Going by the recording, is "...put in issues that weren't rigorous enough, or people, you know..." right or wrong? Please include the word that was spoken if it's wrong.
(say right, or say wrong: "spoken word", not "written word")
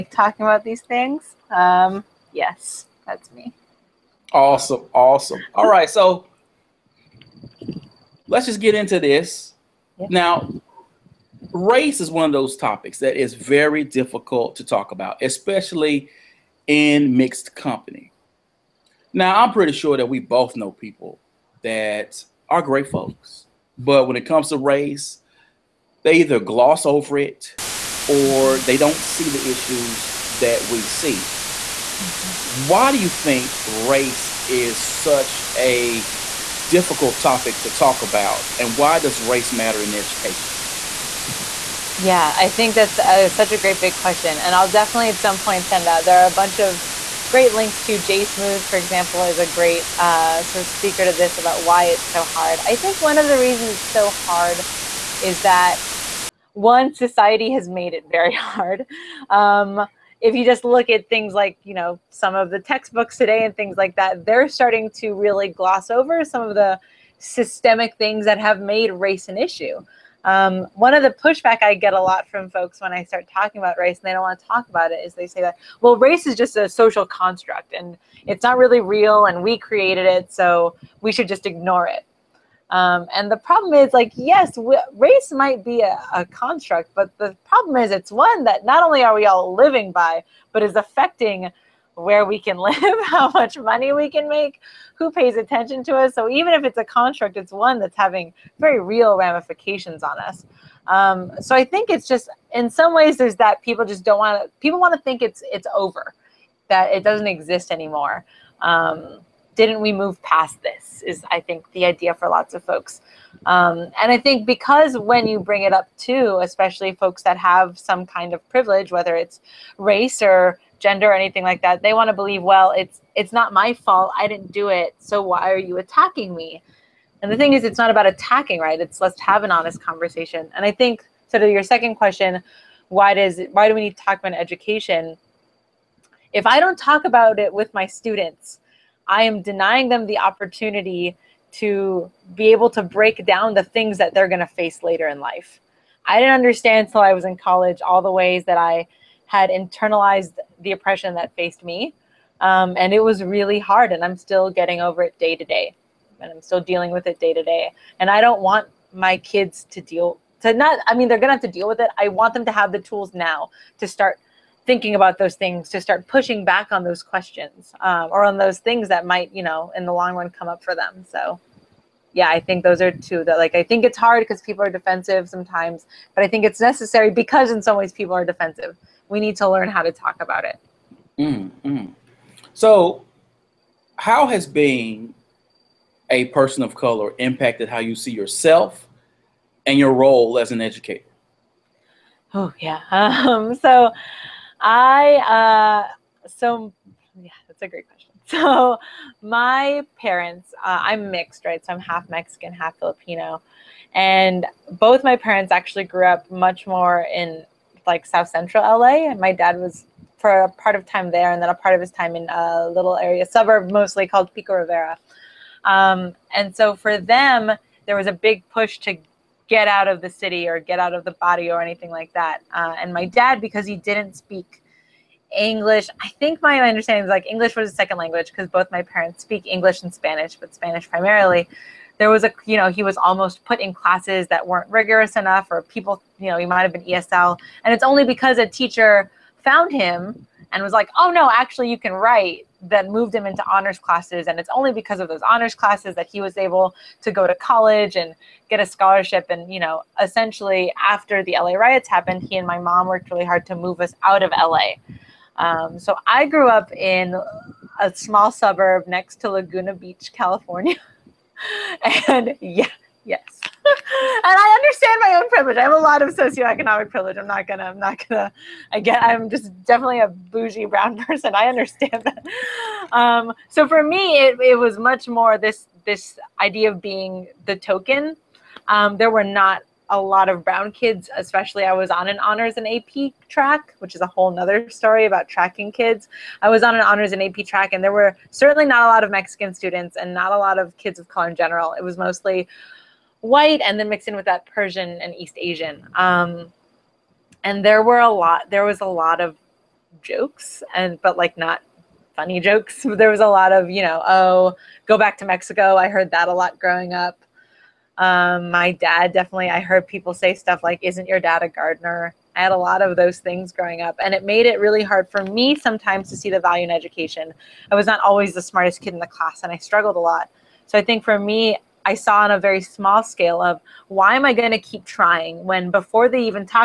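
wrong: "classes", not "issues".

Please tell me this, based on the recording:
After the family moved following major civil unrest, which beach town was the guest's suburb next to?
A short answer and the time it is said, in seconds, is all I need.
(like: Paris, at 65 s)
Laguna Beach, at 259 s.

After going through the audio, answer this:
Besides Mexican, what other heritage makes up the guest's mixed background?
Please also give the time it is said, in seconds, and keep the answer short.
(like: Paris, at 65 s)
Filipino, at 202 s.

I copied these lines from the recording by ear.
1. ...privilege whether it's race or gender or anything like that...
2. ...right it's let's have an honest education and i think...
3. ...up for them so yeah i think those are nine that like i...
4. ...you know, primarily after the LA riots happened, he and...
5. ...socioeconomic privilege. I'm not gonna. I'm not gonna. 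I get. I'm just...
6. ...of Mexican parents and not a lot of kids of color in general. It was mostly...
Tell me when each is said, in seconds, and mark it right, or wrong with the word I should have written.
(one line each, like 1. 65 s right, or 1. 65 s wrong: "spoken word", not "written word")
1. 118 s right
2. 128 s wrong: "conversation", not "education"
3. 170 s wrong: "two", not "nine"
4. 249 s wrong: "essentially", not "primarily"
5. 266 s right
6. 289 s wrong: "students", not "parents".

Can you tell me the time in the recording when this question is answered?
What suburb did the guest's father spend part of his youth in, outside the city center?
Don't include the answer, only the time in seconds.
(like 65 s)
214 s.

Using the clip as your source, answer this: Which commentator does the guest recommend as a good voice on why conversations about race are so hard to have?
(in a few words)
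Jay Smooth.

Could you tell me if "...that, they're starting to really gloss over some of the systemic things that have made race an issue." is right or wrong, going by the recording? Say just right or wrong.
right.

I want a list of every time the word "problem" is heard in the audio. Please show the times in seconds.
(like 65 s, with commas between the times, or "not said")
83 s, 87 s.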